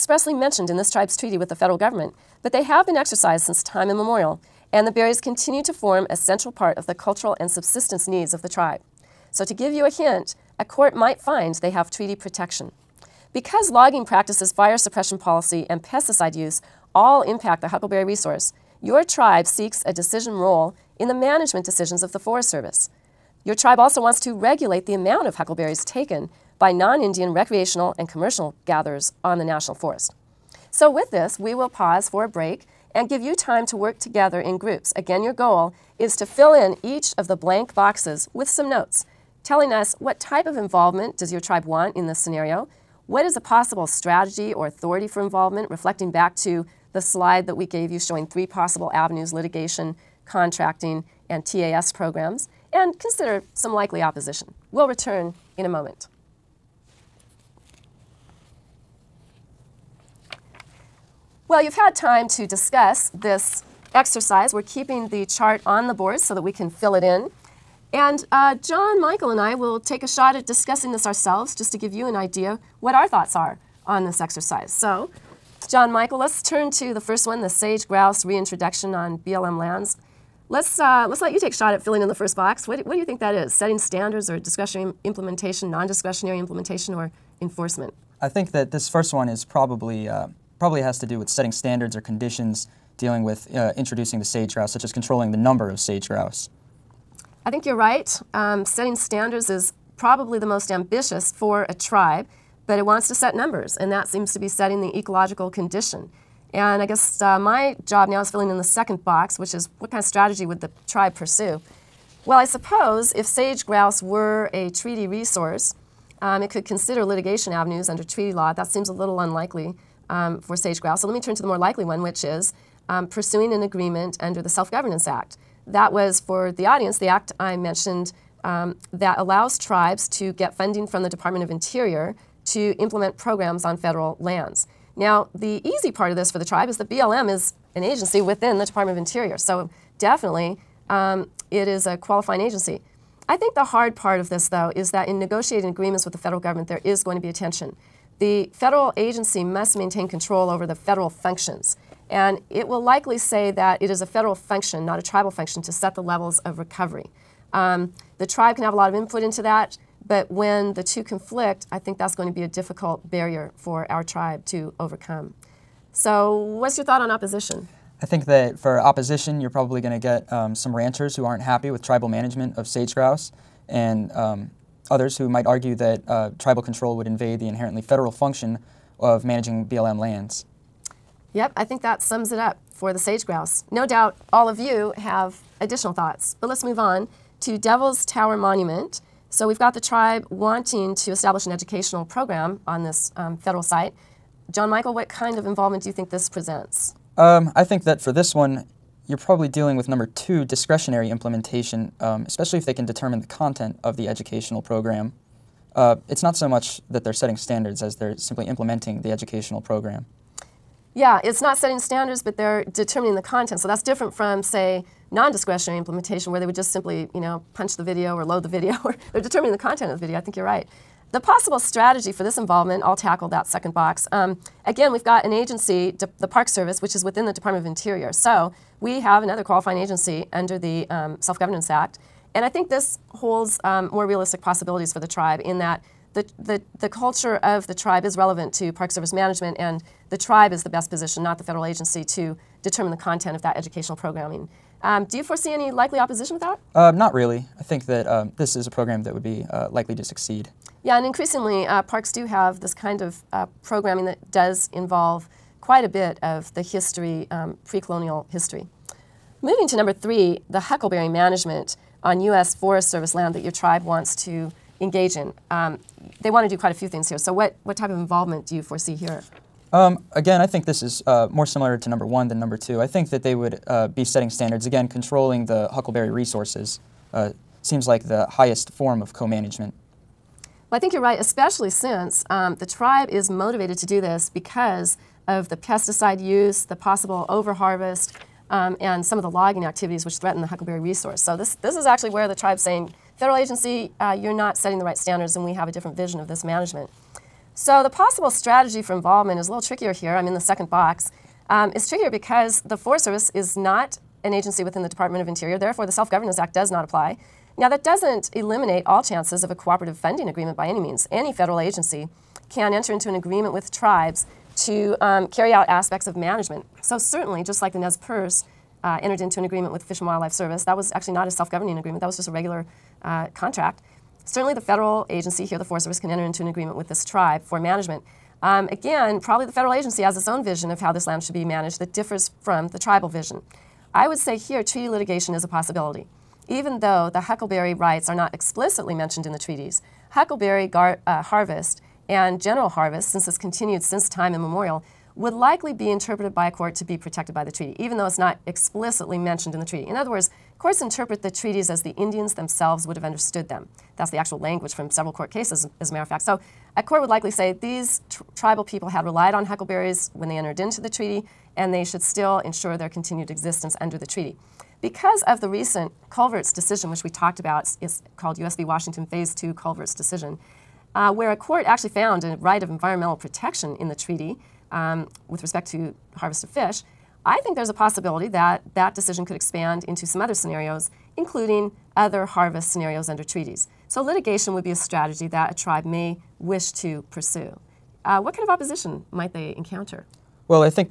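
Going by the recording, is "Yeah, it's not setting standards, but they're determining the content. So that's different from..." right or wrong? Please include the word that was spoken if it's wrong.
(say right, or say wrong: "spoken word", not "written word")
right.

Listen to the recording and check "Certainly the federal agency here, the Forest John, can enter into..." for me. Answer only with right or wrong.
wrong.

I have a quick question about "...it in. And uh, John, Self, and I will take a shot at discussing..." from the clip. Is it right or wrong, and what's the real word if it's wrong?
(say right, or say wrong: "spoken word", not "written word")
wrong: "Michael", not "Self".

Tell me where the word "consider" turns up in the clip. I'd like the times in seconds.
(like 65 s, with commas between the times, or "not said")
52 s, 116 s.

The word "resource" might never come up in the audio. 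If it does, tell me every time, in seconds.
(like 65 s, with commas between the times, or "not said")
18 s, 115 s, 276 s, 290 s.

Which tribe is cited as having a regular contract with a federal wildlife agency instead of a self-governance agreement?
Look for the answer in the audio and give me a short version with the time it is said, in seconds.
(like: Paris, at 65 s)
Nez Perce, at 317 s.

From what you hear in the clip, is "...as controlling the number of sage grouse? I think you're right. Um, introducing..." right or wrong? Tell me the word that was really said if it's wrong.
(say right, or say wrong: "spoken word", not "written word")
wrong: "setting", not "introducing".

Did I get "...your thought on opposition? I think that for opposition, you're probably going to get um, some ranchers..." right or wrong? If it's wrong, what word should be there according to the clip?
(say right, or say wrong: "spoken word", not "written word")
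right.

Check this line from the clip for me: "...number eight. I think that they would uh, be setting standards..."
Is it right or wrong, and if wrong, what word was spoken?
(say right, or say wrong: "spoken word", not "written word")
wrong: "two", not "eight".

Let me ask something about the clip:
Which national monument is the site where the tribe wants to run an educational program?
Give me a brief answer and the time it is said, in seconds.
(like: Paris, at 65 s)
Devil's Tower, at 187 s.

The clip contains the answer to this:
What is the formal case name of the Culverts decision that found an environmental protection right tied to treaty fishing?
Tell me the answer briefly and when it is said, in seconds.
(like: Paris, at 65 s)
U.S. v. Washington Phase 2, at 368 s.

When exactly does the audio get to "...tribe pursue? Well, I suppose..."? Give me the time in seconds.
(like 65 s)
110 s.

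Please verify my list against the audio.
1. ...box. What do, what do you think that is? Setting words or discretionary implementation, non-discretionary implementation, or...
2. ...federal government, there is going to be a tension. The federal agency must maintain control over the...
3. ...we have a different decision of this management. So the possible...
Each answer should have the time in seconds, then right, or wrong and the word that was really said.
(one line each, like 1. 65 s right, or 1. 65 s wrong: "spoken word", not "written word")
1. 82 s wrong: "standards", not "words"
2. 146 s right
3. 295 s wrong: "vision", not "decision".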